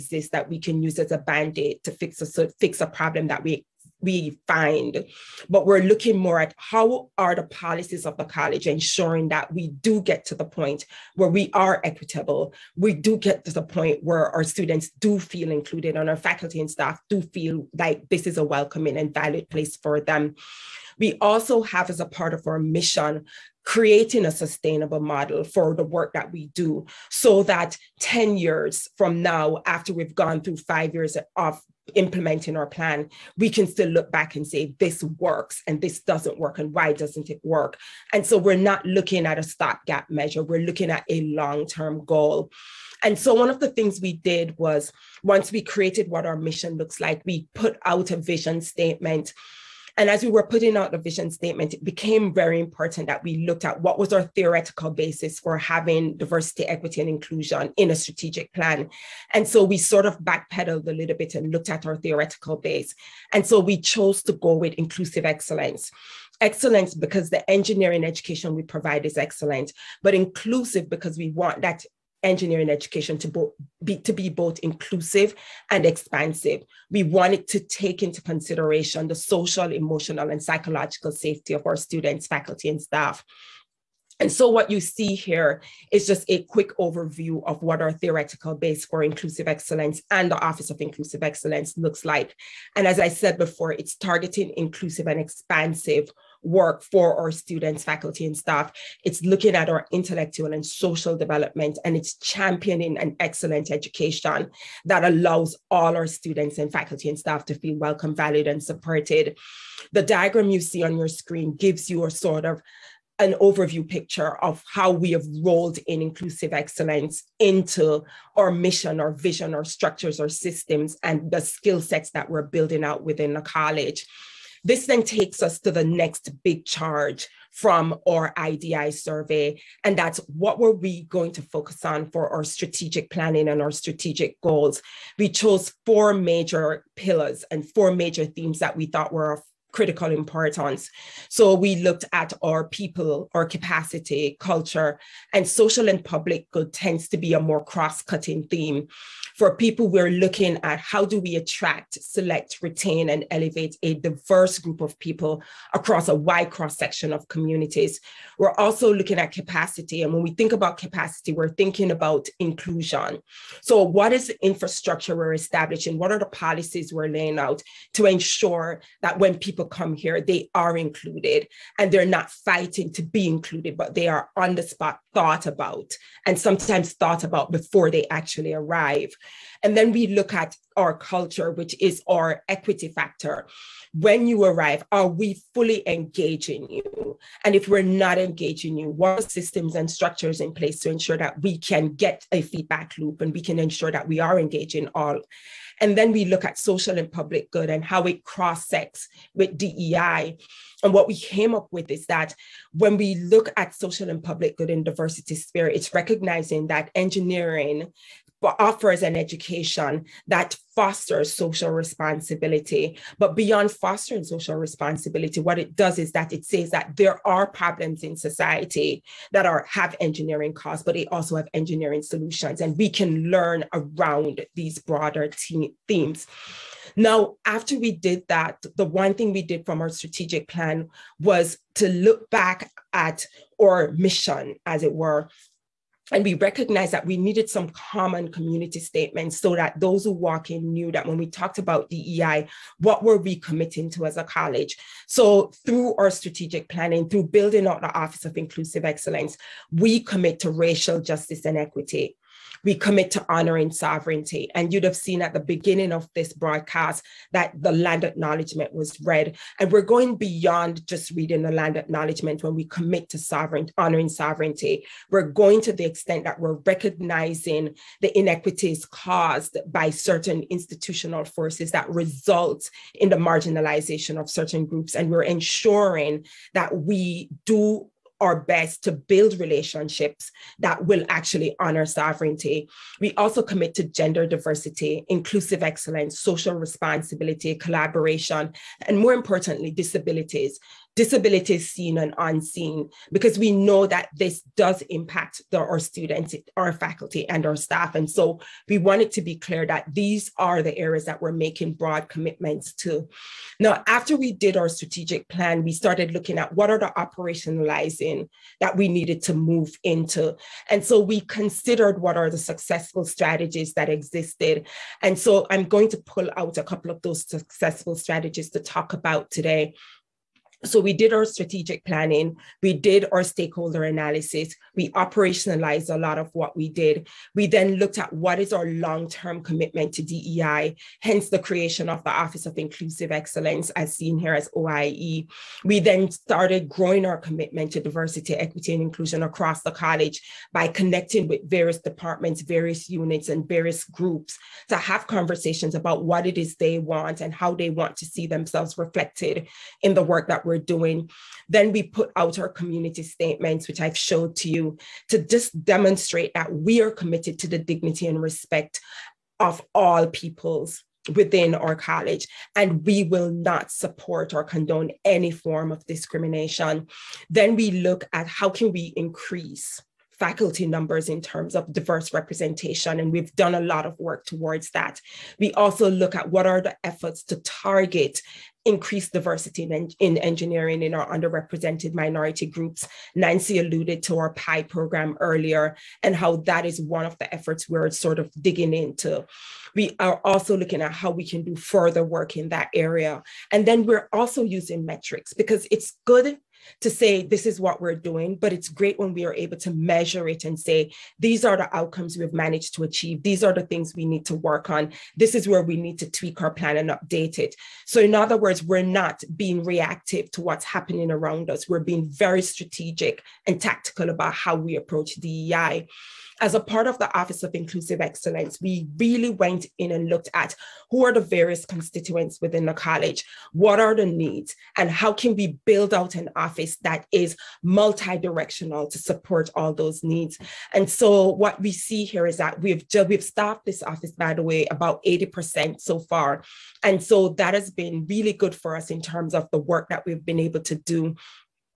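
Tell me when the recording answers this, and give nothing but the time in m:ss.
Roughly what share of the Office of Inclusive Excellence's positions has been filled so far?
7:15.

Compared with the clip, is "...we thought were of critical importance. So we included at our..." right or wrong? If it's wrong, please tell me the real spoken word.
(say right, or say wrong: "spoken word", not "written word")
wrong: "looked", not "included".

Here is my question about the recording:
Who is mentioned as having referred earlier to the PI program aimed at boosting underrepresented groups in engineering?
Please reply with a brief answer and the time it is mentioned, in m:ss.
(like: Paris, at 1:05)
Nancy, at 6:23.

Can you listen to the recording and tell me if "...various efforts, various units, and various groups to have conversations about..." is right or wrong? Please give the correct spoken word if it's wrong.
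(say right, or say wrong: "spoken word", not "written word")
wrong: "departments", not "efforts".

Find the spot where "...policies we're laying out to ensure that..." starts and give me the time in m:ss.
2:46.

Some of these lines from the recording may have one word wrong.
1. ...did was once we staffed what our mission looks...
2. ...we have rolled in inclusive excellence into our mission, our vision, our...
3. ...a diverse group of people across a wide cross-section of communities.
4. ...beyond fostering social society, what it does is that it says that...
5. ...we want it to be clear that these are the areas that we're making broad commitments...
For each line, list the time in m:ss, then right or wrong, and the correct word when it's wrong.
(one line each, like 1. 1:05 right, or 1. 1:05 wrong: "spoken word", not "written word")
1. 0:44 wrong: "created", not "staffed"
2. 1:54 right
3. 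2:33 right
4. 3:33 wrong: "responsibility", not "society"
5. 4:58 right.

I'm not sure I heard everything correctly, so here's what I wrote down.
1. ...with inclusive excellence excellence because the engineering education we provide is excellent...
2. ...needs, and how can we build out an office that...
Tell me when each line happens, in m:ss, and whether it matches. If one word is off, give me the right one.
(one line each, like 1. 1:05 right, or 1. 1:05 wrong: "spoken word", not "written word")
1. 1:04 right
2. 7:04 right.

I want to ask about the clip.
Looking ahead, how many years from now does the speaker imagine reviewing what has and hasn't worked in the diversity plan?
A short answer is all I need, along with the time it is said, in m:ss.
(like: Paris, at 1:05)
10 years, at 0:27.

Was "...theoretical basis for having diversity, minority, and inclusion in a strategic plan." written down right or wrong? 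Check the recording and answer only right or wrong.
wrong.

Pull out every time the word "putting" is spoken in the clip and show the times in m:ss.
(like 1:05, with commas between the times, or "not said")
0:50.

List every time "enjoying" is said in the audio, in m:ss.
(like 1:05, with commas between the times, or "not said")
not said.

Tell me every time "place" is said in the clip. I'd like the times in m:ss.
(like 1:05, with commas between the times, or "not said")
0:19, 3:10.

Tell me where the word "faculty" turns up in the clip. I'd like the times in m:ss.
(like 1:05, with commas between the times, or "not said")
0:16, 1:22, 1:37, 1:46, 4:56, 6:10.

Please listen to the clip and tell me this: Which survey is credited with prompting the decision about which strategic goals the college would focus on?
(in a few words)
IDI survey.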